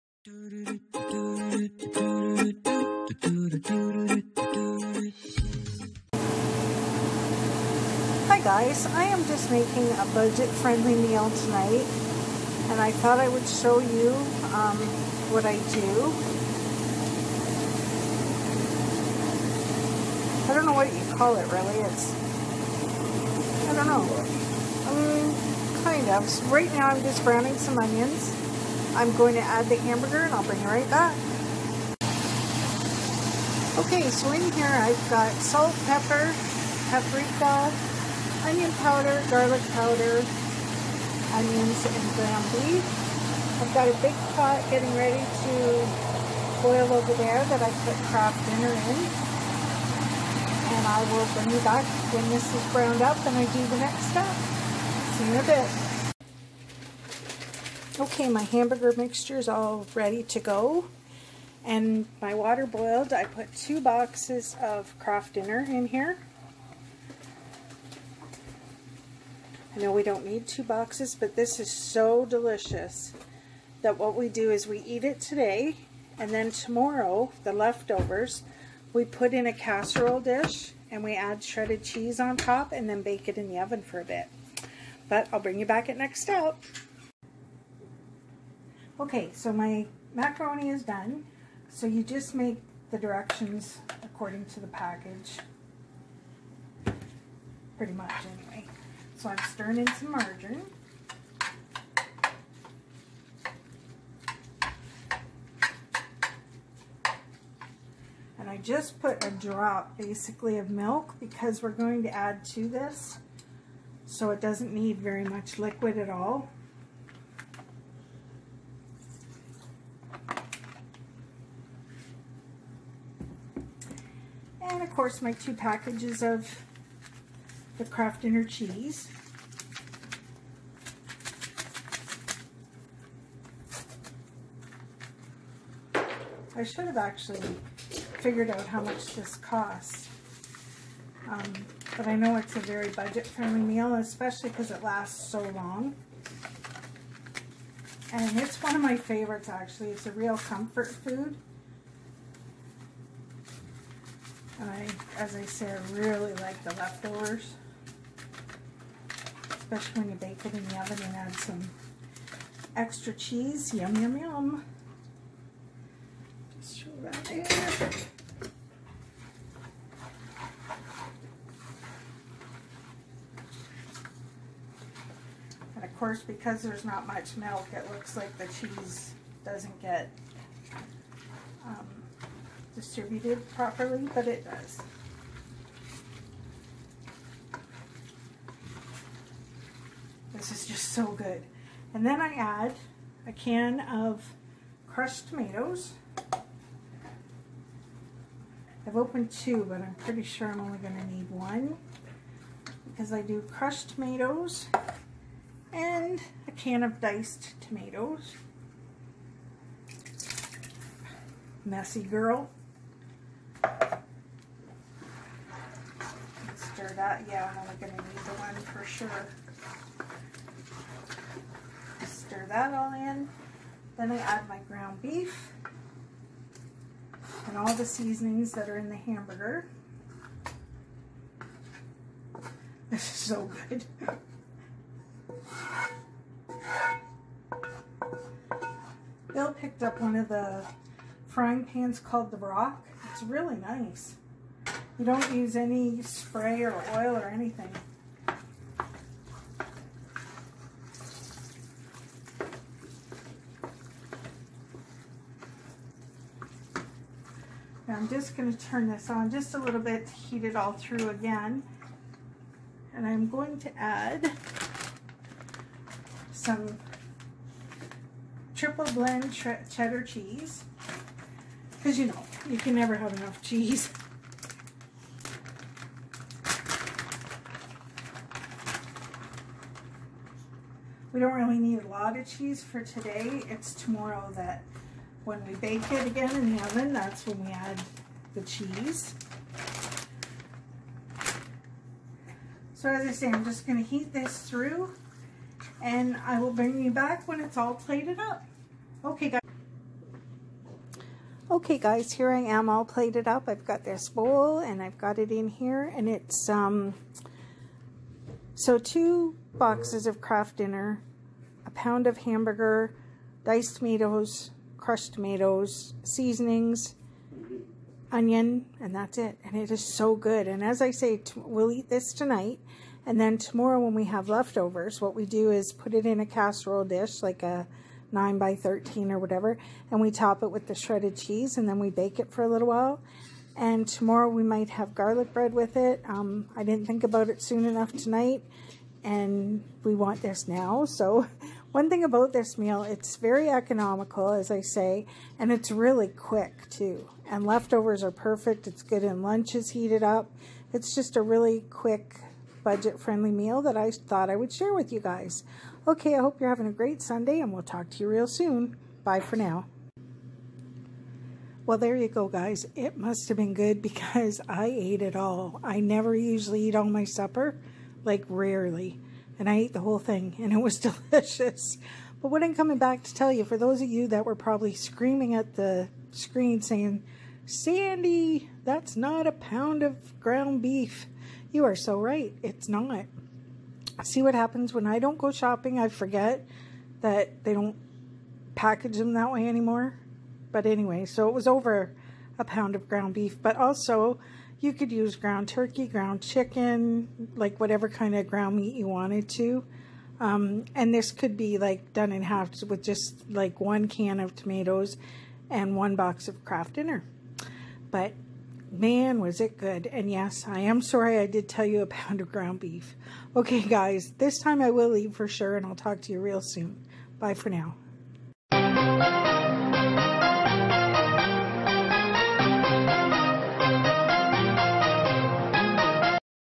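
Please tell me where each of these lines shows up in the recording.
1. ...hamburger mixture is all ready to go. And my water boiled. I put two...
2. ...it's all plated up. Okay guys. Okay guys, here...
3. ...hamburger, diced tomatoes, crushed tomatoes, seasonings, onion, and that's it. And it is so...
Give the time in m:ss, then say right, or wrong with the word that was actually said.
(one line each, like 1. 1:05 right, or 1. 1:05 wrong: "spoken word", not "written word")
1. 0:58 right
2. 4:57 right
3. 5:12 right.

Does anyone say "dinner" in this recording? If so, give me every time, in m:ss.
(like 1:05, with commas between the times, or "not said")
0:48, 1:05, 2:08, 5:10, 6:46.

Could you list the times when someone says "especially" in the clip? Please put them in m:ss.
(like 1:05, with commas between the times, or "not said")
2:23, 2:39.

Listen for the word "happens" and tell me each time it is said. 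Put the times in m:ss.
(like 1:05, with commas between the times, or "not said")
6:24.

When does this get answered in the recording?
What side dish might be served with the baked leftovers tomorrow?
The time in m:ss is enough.
5:34.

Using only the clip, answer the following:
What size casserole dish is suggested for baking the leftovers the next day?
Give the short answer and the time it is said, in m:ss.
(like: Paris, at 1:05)
9 by 13, at 5:28.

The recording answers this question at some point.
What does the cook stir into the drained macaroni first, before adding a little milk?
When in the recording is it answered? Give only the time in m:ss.
1:40.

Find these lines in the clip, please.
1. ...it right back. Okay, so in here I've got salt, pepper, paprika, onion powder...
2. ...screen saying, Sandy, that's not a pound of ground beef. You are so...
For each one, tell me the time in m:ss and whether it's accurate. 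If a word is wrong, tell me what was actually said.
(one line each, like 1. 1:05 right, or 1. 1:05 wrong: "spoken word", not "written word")
1. 0:30 right
2. 6:16 right.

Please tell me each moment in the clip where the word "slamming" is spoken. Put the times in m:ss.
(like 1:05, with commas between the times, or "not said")
not said.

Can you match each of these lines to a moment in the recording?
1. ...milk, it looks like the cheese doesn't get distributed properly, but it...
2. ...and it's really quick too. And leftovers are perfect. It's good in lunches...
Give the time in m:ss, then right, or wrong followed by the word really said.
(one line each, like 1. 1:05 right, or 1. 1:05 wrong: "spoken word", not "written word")
1. 2:57 right
2. 5:45 right.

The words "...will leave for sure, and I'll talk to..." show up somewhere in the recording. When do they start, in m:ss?
6:54.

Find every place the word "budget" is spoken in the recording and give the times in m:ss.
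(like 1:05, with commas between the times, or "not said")
0:10, 2:22, 5:52.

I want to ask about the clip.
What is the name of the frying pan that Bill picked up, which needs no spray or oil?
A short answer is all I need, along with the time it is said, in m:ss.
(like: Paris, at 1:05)
The Rock, at 4:02.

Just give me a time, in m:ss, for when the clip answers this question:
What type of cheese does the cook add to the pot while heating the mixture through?
4:28.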